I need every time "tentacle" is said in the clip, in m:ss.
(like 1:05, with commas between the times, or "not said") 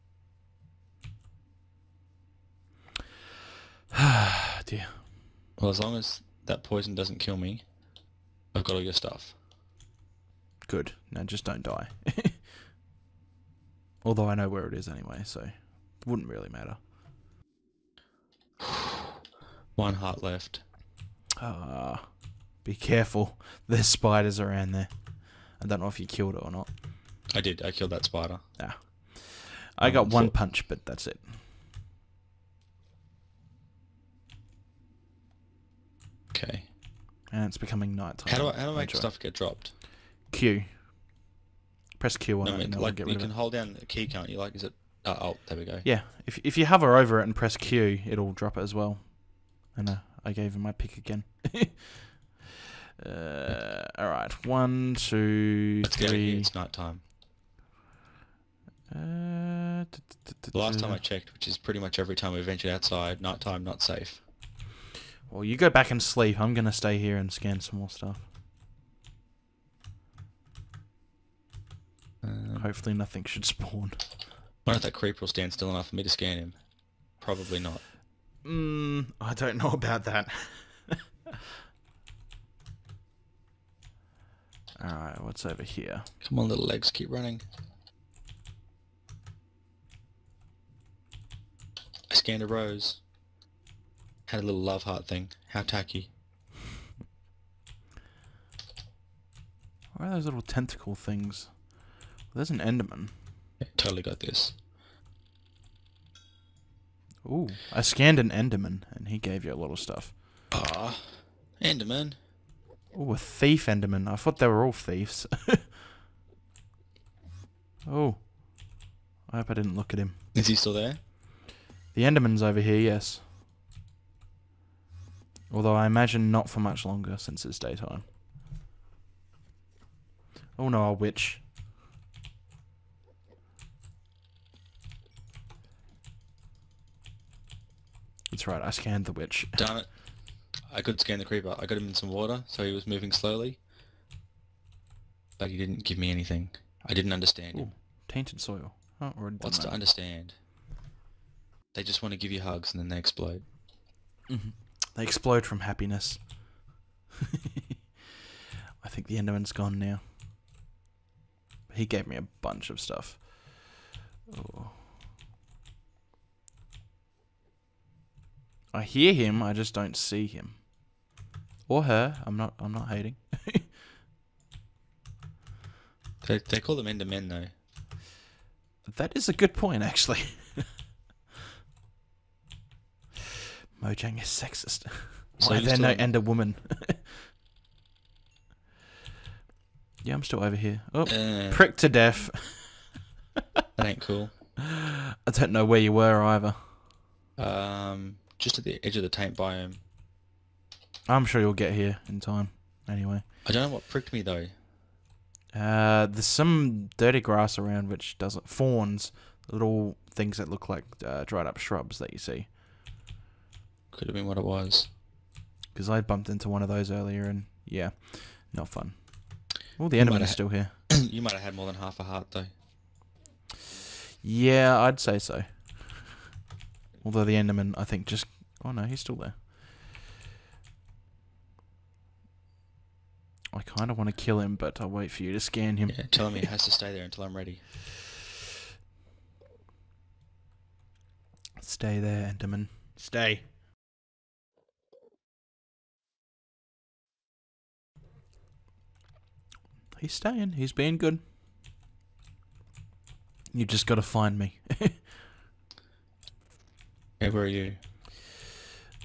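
1:40.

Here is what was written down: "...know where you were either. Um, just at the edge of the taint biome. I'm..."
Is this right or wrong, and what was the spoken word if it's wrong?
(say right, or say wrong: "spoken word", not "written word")
right.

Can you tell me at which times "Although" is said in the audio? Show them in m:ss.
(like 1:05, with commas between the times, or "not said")
0:14, 2:05, 3:47.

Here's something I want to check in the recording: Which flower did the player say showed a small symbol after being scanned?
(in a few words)
Rose.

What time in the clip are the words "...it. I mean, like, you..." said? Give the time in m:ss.
0:42.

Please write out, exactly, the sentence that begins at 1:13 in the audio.
I wonder if that creeper will stand still enough for me to scan him.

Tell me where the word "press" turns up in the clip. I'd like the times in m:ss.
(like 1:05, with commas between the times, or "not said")
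0:41, 0:47.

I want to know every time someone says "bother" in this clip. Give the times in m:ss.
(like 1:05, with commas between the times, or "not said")
not said.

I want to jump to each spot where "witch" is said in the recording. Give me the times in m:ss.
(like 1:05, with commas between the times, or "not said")
2:10, 2:19.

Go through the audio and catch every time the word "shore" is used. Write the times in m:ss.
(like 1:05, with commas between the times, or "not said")
not said.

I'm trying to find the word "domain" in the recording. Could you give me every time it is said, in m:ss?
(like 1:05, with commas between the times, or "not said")
not said.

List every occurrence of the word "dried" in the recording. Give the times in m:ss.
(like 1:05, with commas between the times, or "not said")
3:31.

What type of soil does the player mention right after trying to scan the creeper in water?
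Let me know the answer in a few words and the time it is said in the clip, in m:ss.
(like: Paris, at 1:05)
Tainted soil, at 2:28.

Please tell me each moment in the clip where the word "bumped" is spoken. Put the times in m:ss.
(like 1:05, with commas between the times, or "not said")
3:36.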